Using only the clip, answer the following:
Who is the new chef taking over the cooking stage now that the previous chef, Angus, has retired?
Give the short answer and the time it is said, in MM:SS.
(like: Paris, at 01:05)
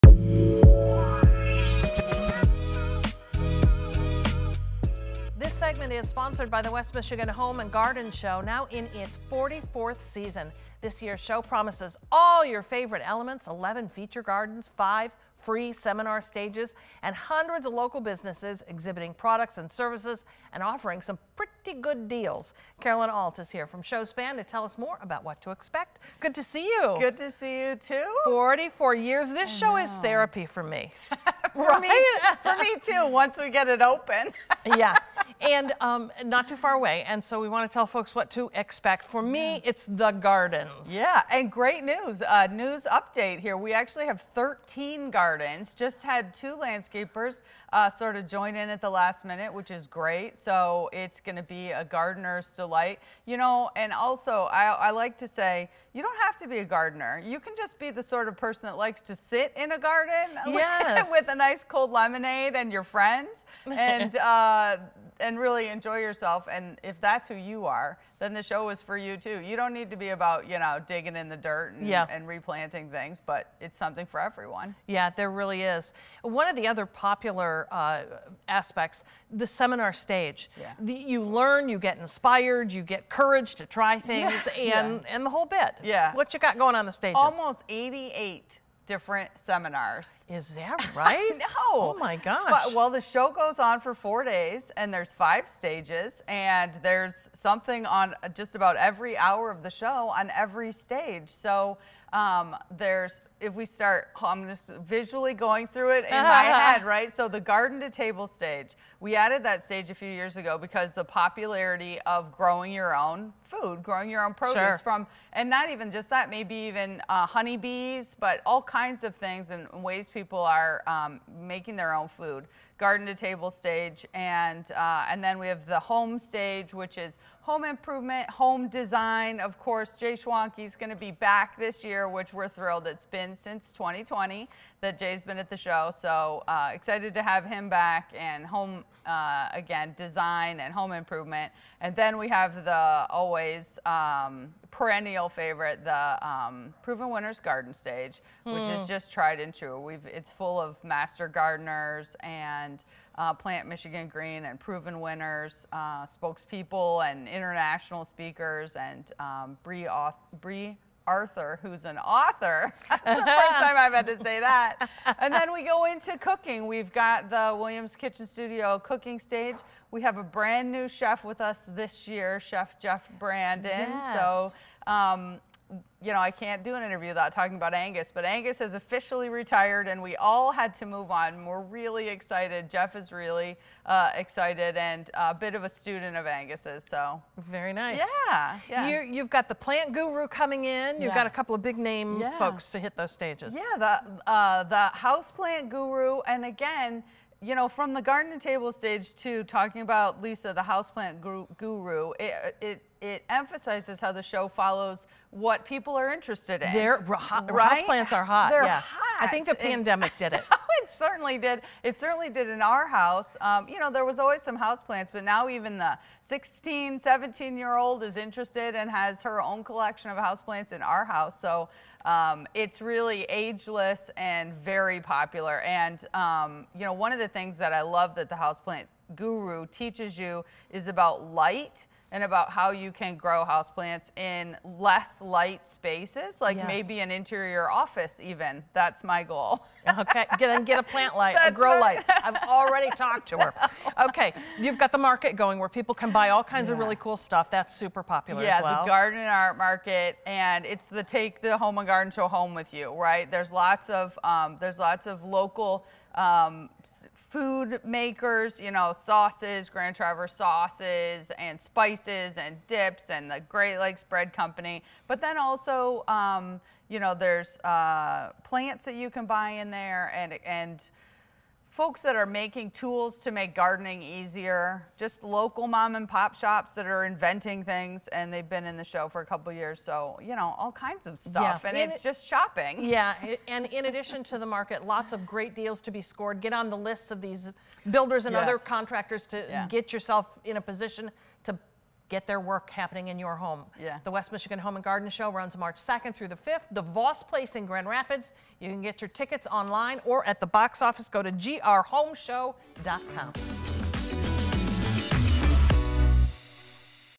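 Chef Jeff Brandon, at 02:52.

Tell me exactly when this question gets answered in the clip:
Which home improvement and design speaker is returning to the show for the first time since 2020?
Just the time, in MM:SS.
02:09.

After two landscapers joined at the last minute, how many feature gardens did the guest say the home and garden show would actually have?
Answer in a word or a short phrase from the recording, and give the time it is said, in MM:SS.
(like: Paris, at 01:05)
13, at 00:44.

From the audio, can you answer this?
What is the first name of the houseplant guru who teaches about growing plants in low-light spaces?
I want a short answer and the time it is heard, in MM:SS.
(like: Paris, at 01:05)
Lisa, at 03:20.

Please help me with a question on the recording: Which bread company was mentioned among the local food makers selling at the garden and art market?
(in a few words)
Great Lakes Bread Company.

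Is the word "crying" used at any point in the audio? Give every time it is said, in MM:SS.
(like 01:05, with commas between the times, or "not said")
not said.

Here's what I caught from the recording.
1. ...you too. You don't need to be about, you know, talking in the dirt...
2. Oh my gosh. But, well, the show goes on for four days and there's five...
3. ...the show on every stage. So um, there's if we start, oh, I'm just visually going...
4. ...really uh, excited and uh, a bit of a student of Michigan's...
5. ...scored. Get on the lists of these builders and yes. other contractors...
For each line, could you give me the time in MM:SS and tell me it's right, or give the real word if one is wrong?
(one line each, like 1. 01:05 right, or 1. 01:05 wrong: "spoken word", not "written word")
1. 01:08 wrong: "digging", not "talking"
2. 01:31 right
3. 01:39 right
4. 03:03 wrong: "Angus", not "Michigan"
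5. 04:46 right.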